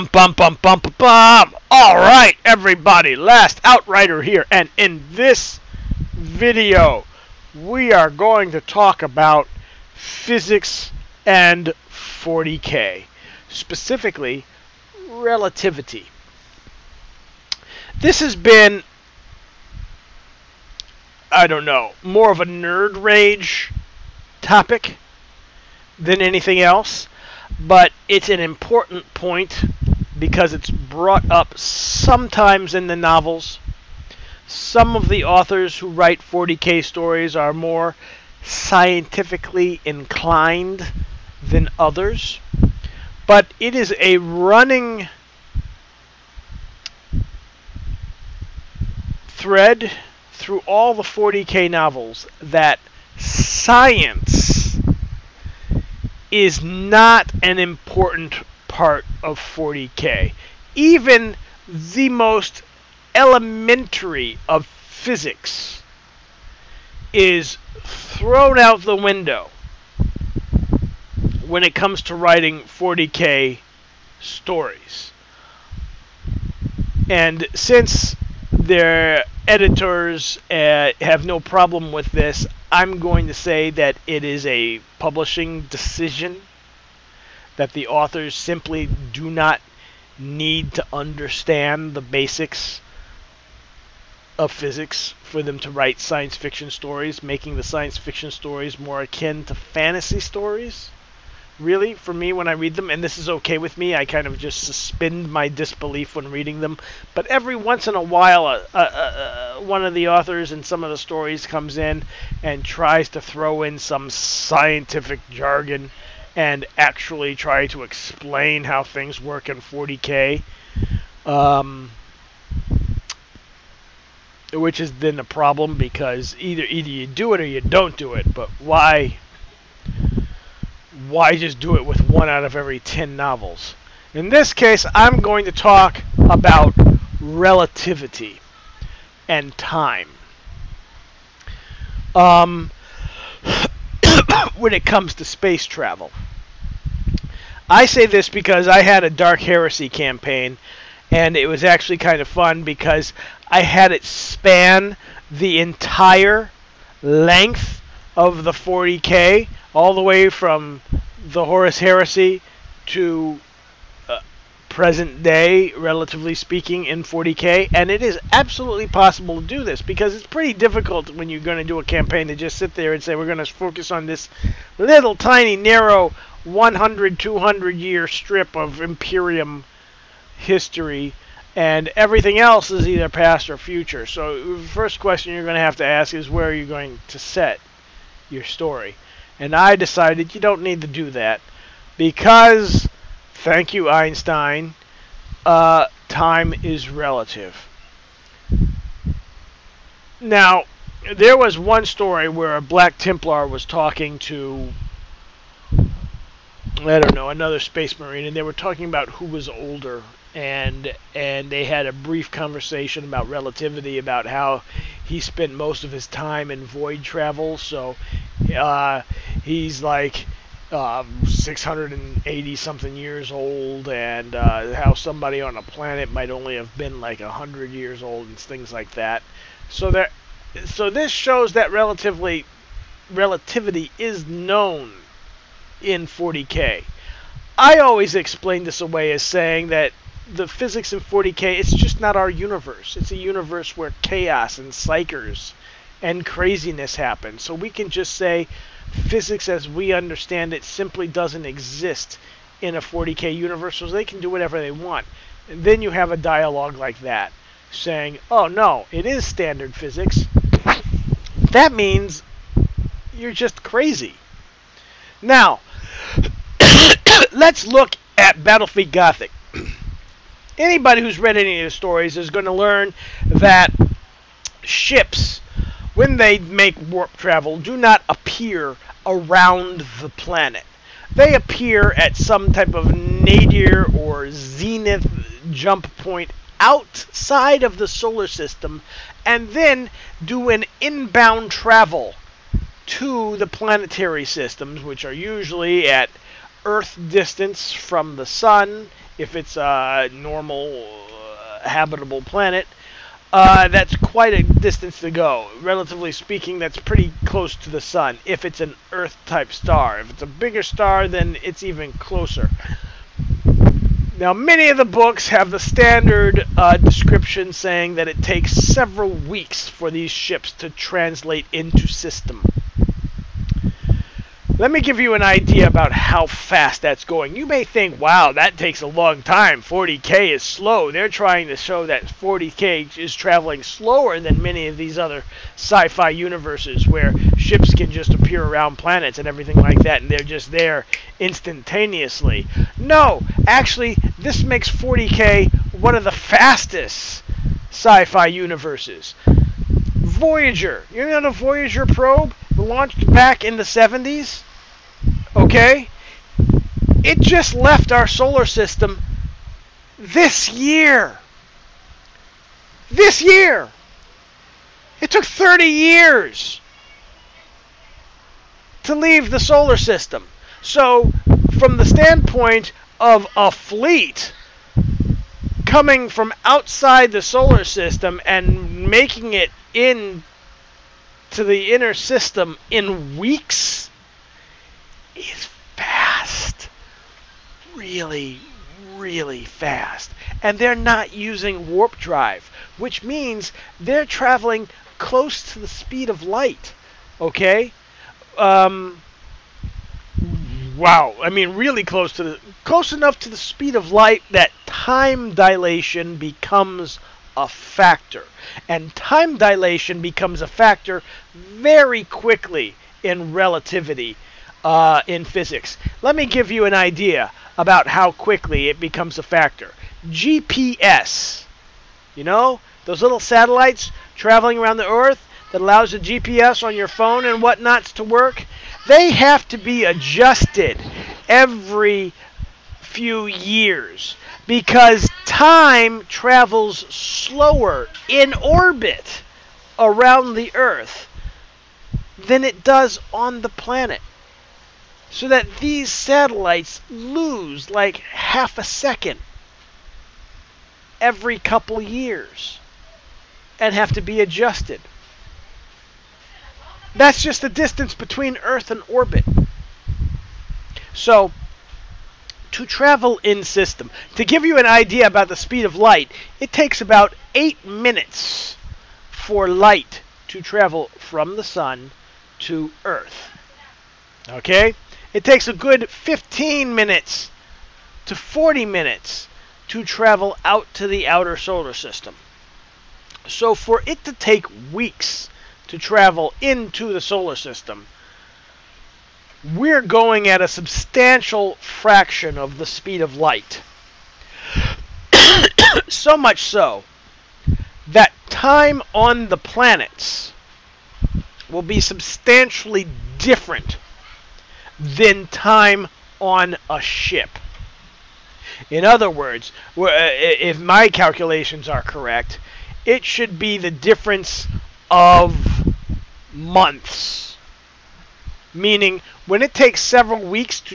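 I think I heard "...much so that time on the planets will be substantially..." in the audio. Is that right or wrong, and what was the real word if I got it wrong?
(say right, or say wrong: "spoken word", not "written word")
right.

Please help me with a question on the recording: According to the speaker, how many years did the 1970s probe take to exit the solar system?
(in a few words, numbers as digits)
30.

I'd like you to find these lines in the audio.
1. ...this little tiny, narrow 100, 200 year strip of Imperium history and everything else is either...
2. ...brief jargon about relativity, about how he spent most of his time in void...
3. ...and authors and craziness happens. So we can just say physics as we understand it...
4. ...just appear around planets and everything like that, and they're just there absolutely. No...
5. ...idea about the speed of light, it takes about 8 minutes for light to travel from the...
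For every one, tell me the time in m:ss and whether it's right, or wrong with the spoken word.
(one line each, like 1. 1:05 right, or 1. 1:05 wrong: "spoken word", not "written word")
1. 2:54 right
2. 3:31 wrong: "conversation", not "jargon"
3. 4:04 wrong: "psykers", not "authors"
4. 5:37 wrong: "instantaneously", not "absolutely"
5. 7:44 right.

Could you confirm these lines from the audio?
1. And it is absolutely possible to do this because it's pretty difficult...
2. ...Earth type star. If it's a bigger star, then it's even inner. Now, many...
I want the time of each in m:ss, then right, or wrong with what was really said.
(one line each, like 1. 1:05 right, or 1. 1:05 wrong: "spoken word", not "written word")
1. 2:47 right
2. 5:08 wrong: "closer", not "inner".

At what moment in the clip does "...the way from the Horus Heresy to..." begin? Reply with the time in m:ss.
2:39.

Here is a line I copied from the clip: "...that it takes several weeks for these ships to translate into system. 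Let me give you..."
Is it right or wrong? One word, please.
right.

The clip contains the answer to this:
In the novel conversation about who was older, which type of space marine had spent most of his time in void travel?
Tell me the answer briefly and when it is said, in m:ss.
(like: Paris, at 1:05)
Black Templar, at 3:22.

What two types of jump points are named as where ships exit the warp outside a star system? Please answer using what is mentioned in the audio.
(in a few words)
nadir or zenith.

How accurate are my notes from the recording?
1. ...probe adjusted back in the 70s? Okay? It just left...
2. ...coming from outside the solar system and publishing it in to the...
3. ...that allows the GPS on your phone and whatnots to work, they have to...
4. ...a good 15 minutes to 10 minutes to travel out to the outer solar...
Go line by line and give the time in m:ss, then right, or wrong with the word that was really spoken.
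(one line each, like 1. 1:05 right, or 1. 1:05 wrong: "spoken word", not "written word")
1. 5:51 wrong: "launched", not "adjusted"
2. 6:15 wrong: "making", not "publishing"
3. 7:05 right
4. 7:55 wrong: "40", not "10".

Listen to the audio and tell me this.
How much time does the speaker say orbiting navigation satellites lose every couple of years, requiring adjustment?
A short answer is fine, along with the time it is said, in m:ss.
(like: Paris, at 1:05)
half a second, at 7:27.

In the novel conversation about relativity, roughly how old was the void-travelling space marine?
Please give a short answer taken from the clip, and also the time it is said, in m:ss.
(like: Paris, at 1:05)
680, at 3:41.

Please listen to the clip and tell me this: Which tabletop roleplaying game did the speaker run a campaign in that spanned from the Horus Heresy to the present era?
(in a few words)
Dark Heresy.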